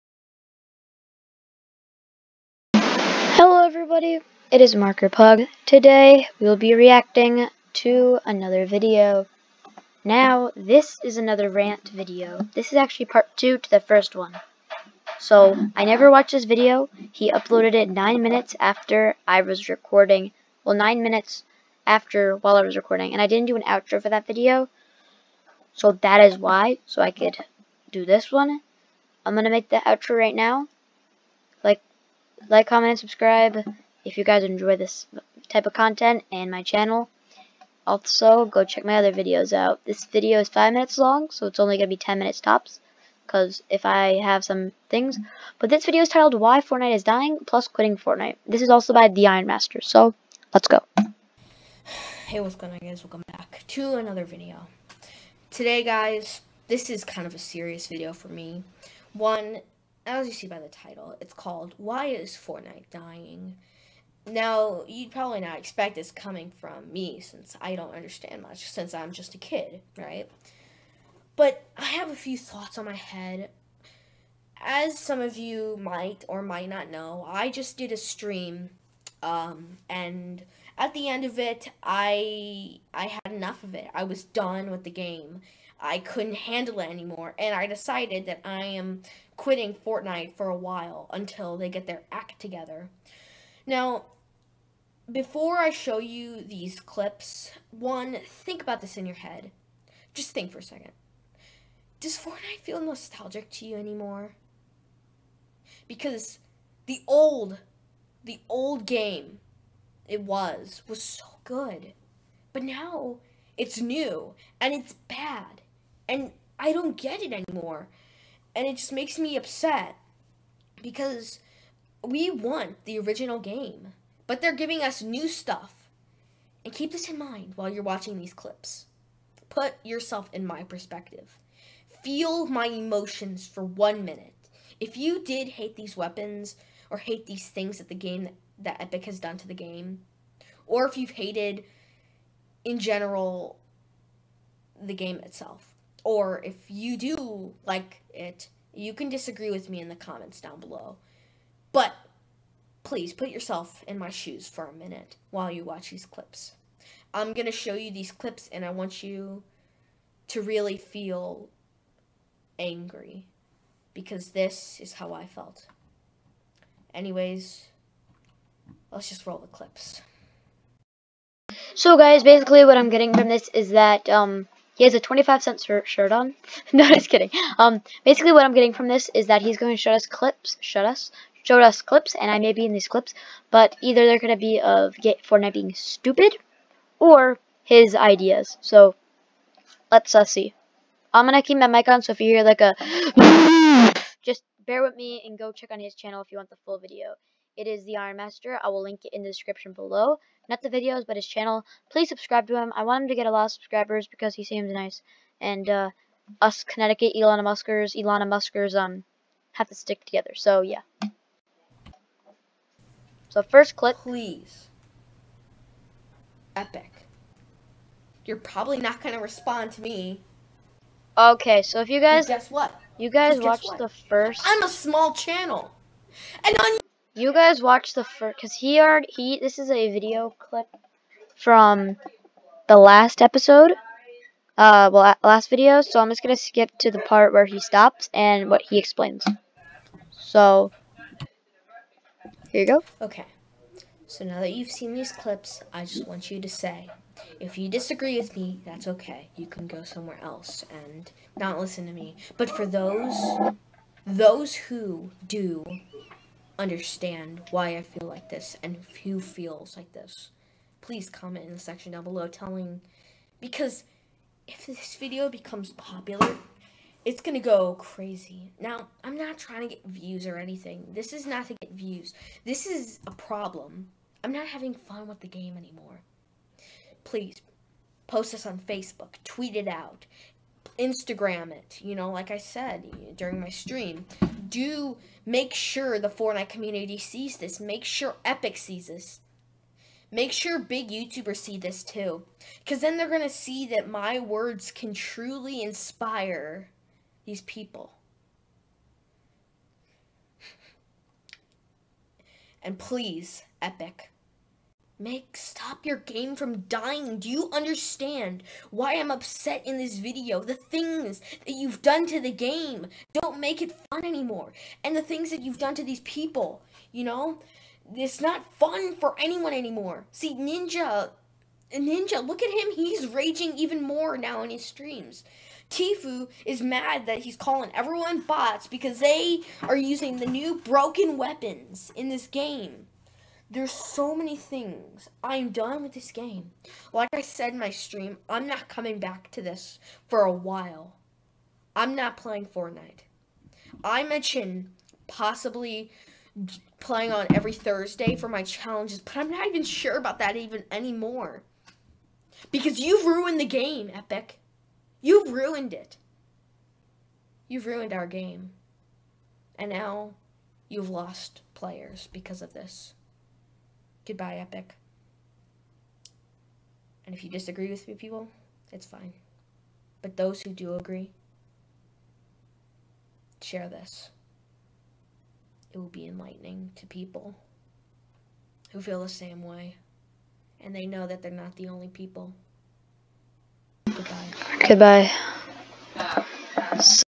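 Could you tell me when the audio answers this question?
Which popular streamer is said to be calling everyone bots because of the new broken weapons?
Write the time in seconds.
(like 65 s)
325 s.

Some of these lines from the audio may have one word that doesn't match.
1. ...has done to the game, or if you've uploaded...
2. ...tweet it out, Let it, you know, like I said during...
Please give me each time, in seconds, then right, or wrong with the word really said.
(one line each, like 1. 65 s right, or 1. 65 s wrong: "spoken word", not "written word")
1. 139 s wrong: "hated", not "uploaded"
2. 279 s wrong: "Instagram", not "Let".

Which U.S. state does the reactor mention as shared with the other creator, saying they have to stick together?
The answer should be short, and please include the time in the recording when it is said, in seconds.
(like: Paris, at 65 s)
Connecticut, at 206 s.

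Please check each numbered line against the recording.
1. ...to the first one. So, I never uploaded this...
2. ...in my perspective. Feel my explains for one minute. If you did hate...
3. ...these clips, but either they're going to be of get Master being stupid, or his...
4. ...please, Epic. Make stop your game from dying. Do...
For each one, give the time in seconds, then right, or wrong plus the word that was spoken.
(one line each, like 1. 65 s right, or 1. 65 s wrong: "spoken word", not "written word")
1. 13 s wrong: "watched", not "uploaded"
2. 130 s wrong: "emotions", not "explains"
3. 182 s wrong: "Fortnite", not "Master"
4. 302 s right.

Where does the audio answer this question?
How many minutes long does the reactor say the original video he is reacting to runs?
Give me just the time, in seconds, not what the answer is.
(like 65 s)
40 s.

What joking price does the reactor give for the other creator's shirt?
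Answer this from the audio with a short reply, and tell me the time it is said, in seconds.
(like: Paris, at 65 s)
25 cents, at 174 s.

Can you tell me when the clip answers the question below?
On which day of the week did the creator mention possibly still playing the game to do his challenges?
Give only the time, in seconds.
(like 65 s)
347 s.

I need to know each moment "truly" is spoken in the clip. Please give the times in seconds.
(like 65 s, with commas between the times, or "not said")
294 s.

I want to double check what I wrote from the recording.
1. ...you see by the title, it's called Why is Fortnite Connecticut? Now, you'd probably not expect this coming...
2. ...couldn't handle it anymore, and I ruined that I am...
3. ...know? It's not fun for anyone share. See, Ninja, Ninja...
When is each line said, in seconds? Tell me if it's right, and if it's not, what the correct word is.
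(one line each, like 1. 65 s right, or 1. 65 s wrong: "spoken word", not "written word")
1. 60 s wrong: "Dying", not "Connecticut"
2. 85 s wrong: "decided", not "ruined"
3. 317 s wrong: "anymore", not "share".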